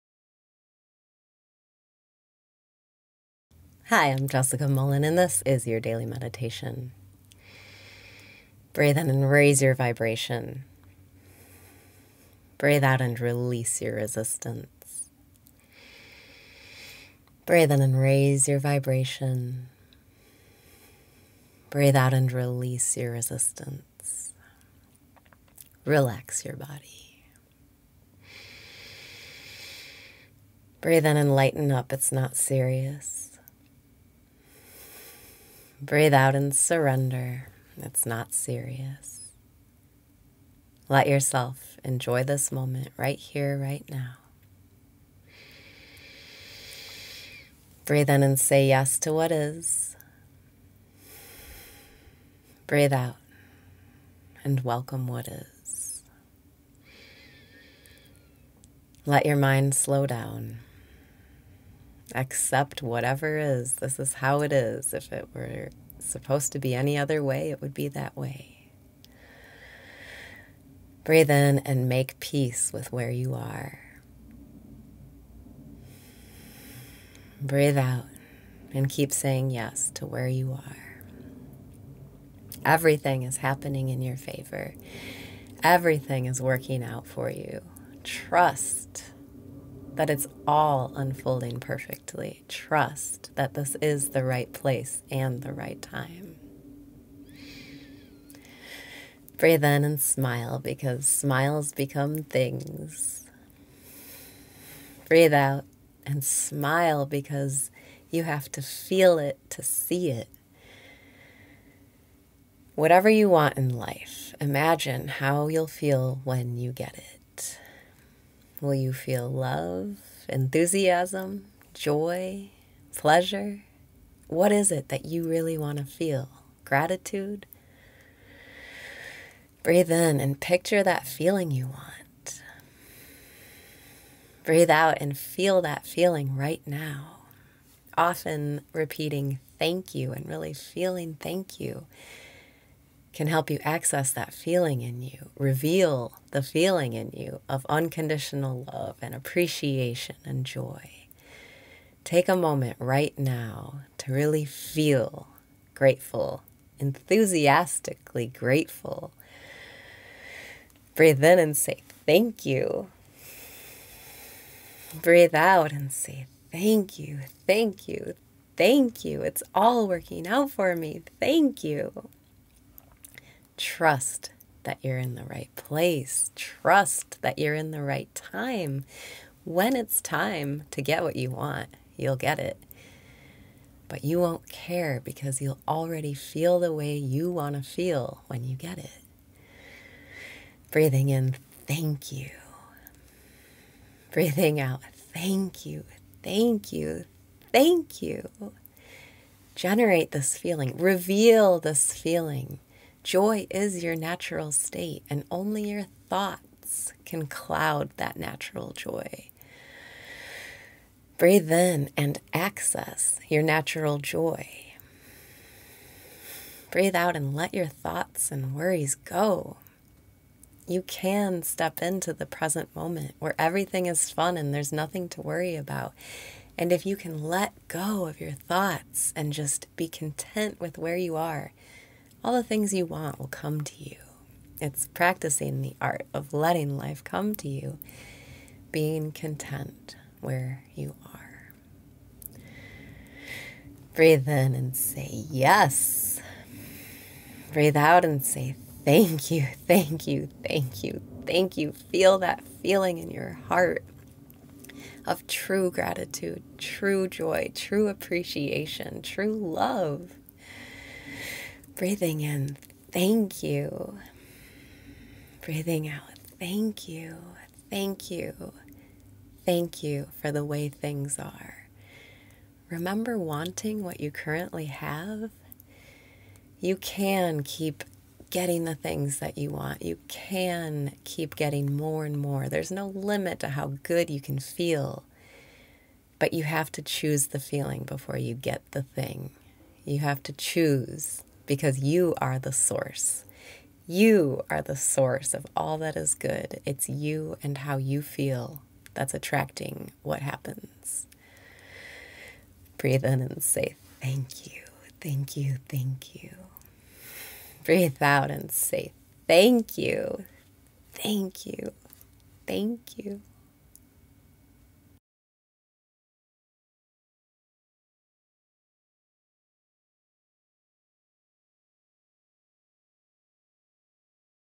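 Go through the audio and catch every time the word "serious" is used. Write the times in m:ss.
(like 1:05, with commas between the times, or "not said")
0:32, 0:38.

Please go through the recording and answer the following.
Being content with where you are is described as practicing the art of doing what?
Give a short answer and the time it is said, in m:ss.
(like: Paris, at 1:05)
letting life come to you, at 3:56.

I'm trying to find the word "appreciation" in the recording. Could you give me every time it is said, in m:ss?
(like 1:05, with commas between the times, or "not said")
2:29, 4:17.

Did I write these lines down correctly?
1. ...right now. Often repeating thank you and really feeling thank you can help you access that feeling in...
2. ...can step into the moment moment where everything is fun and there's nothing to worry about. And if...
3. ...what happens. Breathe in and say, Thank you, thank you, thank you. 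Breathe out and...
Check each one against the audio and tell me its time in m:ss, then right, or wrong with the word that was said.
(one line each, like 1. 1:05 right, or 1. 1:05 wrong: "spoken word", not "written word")
1. 2:16 right
2. 3:40 wrong: "present", not "moment"
3. 5:00 right.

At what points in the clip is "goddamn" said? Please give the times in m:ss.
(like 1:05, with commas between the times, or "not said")
not said.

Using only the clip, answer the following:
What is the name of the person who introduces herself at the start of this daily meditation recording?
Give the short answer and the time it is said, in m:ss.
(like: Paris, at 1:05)
Jessica Mullen, at 0:04.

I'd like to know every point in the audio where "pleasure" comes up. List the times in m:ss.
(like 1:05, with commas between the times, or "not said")
2:02.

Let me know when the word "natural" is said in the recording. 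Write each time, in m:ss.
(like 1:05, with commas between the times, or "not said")
3:23, 3:28, 3:33.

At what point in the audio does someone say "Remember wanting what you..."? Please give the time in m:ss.
4:32.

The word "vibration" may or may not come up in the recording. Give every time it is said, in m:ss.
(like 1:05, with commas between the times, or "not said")
0:09, 0:18.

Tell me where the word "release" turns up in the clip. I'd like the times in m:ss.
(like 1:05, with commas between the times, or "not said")
0:13, 0:22.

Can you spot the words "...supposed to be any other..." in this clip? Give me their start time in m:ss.
1:05.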